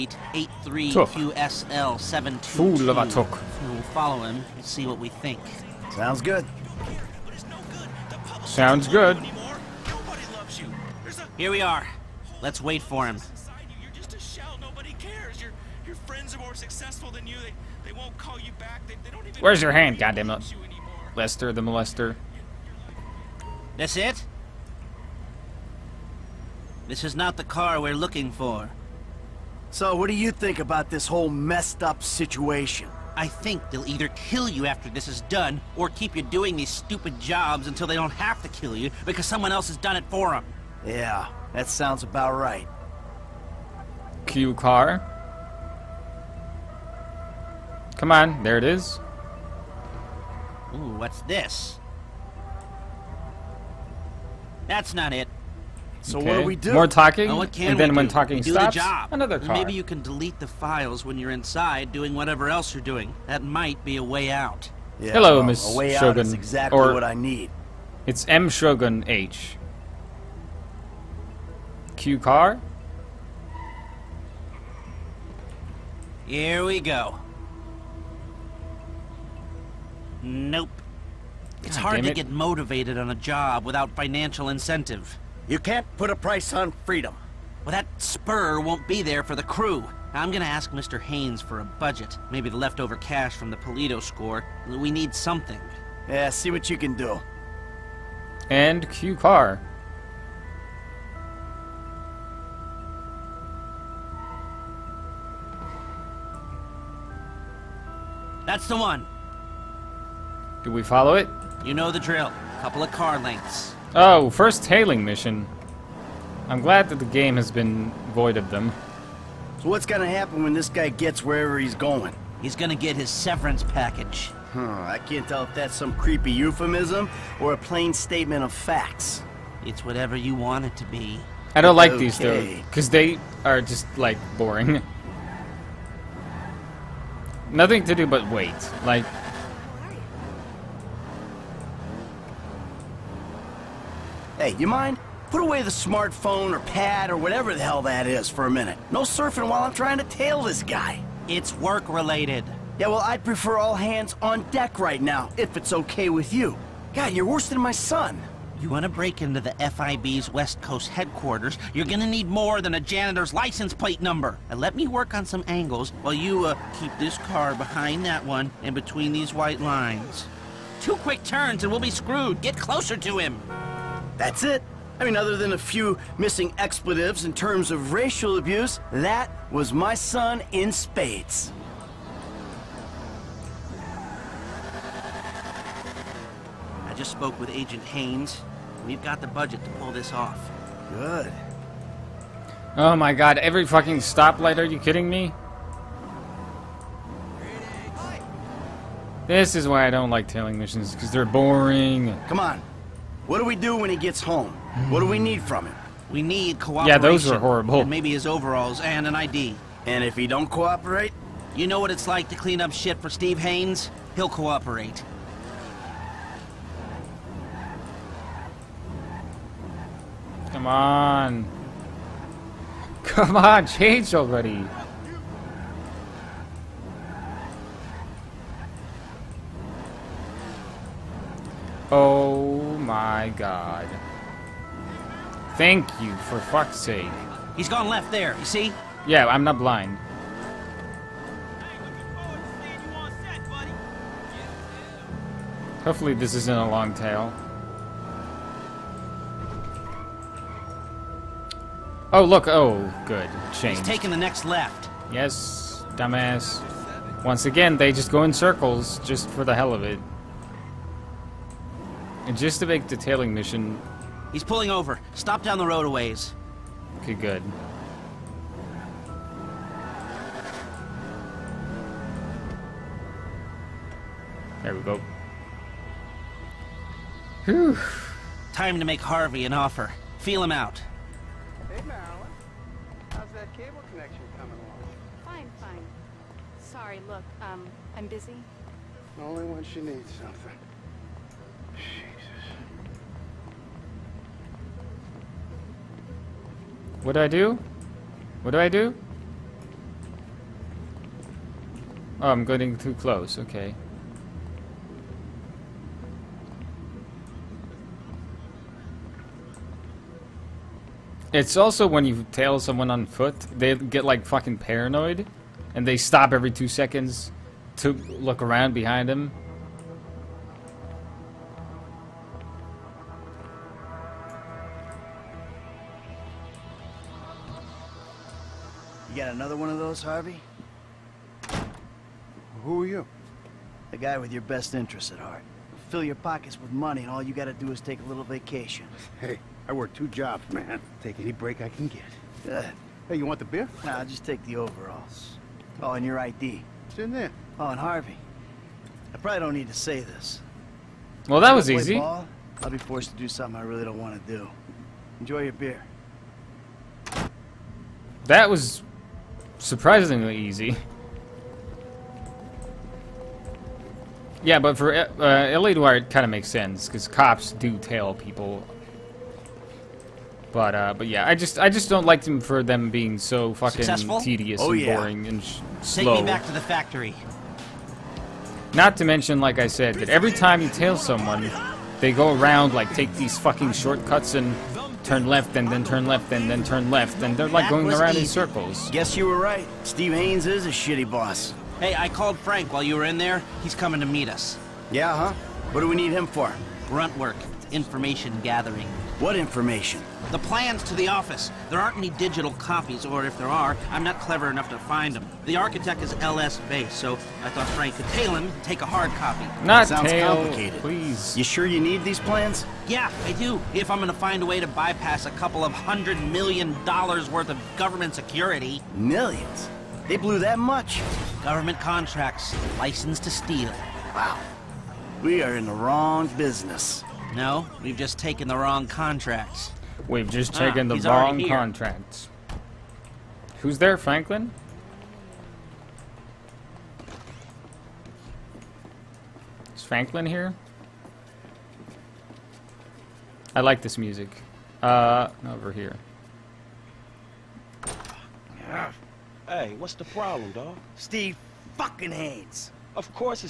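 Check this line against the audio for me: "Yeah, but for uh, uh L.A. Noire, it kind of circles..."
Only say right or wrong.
wrong.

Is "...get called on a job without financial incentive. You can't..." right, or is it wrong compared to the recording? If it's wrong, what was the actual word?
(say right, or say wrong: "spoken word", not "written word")
wrong: "motivated", not "called".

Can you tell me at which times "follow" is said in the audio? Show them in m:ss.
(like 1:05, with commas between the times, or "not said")
0:03, 1:50.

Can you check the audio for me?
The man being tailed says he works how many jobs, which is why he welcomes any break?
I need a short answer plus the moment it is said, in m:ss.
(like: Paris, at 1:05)
2, at 5:39.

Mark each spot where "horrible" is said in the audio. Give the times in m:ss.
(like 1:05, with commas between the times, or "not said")
3:27.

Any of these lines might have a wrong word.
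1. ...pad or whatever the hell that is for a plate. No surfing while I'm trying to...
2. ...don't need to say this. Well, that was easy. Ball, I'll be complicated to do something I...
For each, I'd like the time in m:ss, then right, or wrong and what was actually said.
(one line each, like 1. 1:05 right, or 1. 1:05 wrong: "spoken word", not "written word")
1. 2:26 wrong: "minute", not "plate"
2. 5:49 wrong: "forced", not "complicated".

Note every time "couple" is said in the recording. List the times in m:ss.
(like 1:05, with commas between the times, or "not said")
1:52, 6:55.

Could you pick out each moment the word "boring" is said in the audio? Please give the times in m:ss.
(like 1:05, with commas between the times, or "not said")
2:14, 3:21, 6:14.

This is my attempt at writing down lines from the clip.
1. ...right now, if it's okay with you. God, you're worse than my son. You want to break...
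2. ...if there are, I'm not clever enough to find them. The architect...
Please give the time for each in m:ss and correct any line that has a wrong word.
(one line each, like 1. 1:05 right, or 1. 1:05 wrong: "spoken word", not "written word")
1. 2:34 right
2. 6:43 right.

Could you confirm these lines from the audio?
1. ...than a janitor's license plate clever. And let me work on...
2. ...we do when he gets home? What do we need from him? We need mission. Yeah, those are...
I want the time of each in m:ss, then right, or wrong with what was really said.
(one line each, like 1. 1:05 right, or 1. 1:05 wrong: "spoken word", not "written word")
1. 2:42 wrong: "number", not "clever"
2. 3:23 wrong: "cooperation", not "mission".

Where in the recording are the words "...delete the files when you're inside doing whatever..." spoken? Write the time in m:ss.
1:00.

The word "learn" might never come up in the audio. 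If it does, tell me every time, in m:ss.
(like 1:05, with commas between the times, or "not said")
not said.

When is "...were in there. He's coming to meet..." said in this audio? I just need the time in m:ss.
6:32.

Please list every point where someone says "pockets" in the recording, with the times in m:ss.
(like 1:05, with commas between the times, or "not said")
5:36.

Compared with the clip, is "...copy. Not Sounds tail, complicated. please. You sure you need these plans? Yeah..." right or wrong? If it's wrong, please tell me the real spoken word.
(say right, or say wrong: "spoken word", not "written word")
right.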